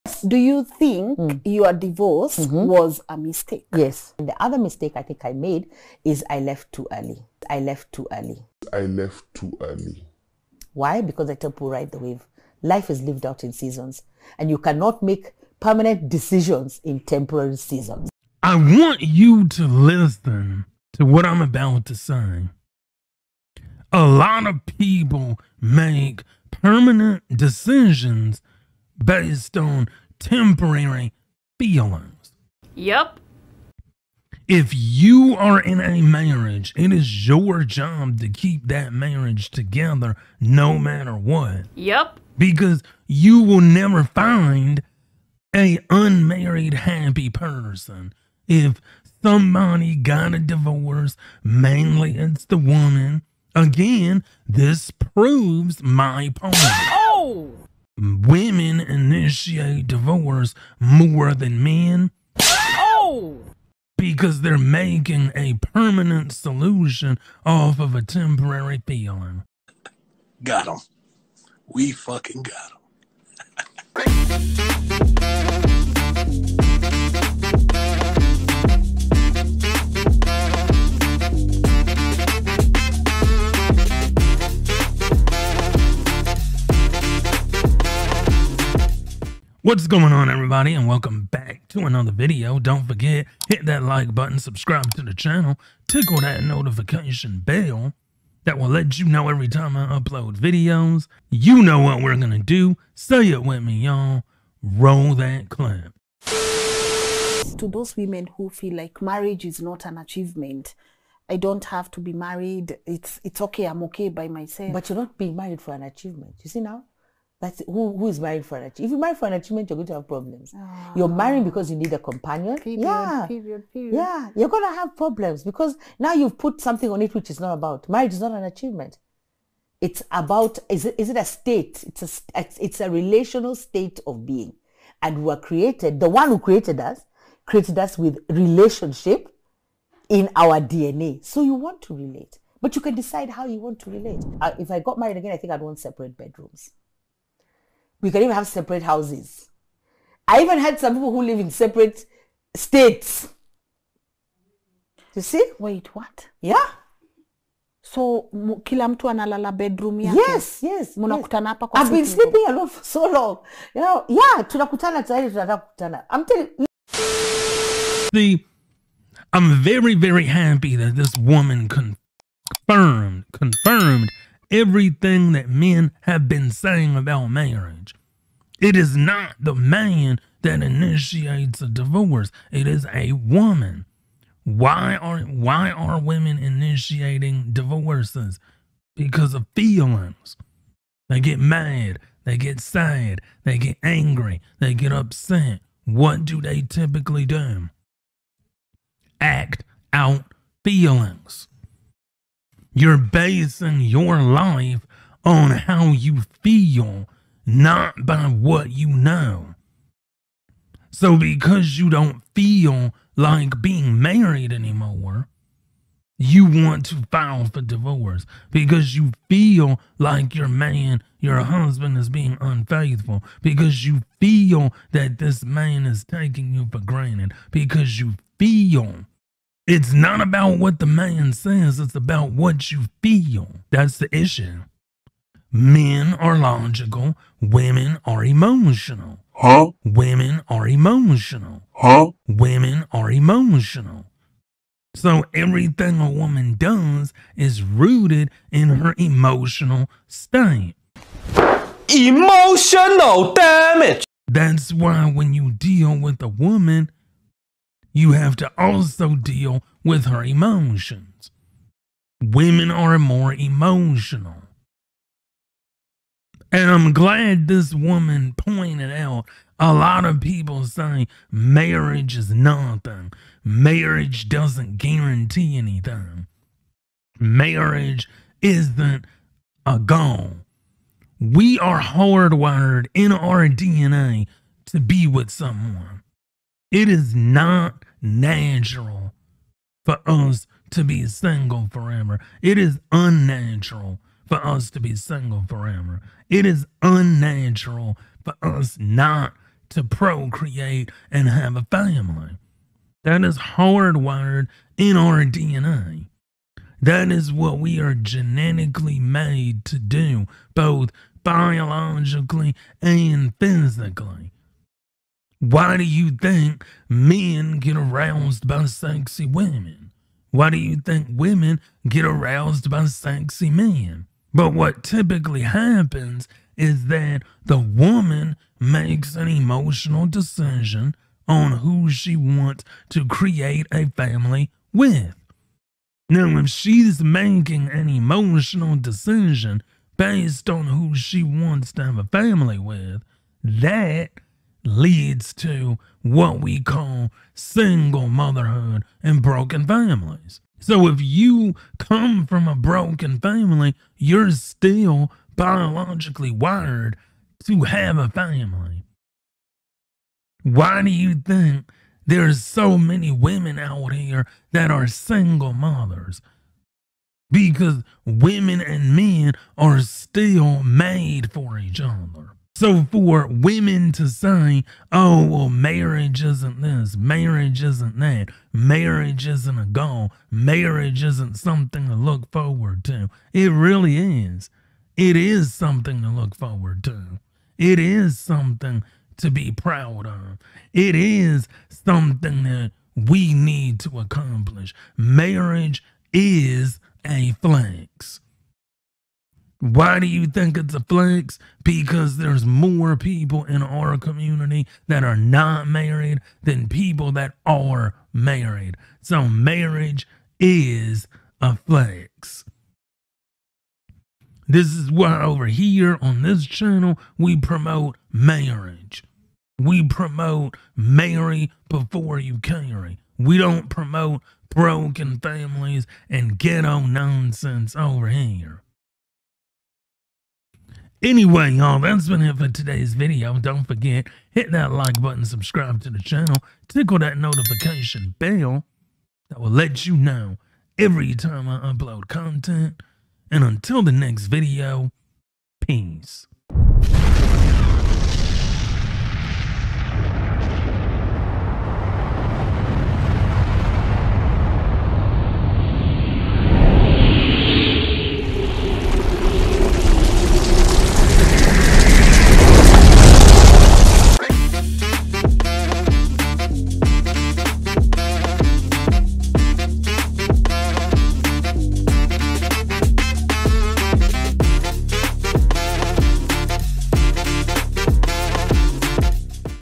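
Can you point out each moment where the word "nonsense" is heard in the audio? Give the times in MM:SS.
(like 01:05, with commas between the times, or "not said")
07:06.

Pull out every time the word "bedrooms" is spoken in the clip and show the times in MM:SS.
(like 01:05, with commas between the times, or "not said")
02:26, 02:39.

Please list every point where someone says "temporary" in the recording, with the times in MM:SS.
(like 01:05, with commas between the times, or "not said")
00:16, 00:30, 01:08.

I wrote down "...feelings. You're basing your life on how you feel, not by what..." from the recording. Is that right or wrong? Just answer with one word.
right.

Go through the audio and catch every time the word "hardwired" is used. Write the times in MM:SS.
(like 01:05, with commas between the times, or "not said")
04:41, 05:03.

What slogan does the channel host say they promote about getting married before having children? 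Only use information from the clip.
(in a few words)
Marry before you carry.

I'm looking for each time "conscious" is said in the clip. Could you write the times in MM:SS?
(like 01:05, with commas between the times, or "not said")
not said.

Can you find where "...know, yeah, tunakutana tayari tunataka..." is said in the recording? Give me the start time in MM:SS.
02:43.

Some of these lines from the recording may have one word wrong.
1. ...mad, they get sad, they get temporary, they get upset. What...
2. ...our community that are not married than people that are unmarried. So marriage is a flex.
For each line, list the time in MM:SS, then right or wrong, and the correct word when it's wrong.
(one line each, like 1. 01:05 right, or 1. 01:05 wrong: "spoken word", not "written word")
1. 03:11 wrong: "angry", not "temporary"
2. 06:43 wrong: "married", not "unmarried".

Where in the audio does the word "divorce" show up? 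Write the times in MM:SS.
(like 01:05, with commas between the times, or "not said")
00:01, 00:50, 00:59, 03:01, 03:07, 03:37.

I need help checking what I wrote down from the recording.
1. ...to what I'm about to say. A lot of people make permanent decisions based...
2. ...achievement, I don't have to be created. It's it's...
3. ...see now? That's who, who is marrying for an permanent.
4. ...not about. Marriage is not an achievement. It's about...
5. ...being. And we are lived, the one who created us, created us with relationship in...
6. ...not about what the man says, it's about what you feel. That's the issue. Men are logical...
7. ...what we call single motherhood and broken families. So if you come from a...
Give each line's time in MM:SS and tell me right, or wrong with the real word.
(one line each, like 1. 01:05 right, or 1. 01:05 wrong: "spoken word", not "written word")
1. 00:20 right
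2. 01:49 wrong: "married", not "created"
3. 01:56 wrong: "achievement", not "permanent"
4. 02:07 right
5. 02:14 wrong: "created", not "lived"
6. 03:49 right
7. 05:46 right.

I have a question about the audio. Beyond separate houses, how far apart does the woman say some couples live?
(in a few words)
Separate states.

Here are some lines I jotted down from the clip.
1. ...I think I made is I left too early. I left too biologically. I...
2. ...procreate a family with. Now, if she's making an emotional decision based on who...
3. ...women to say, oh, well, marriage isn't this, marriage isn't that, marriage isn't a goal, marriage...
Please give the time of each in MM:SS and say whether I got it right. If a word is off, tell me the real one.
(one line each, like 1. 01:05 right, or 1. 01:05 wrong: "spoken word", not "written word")
1. 00:04 wrong: "early", not "biologically"
2. 05:33 wrong: "create", not "procreate"
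3. 06:13 right.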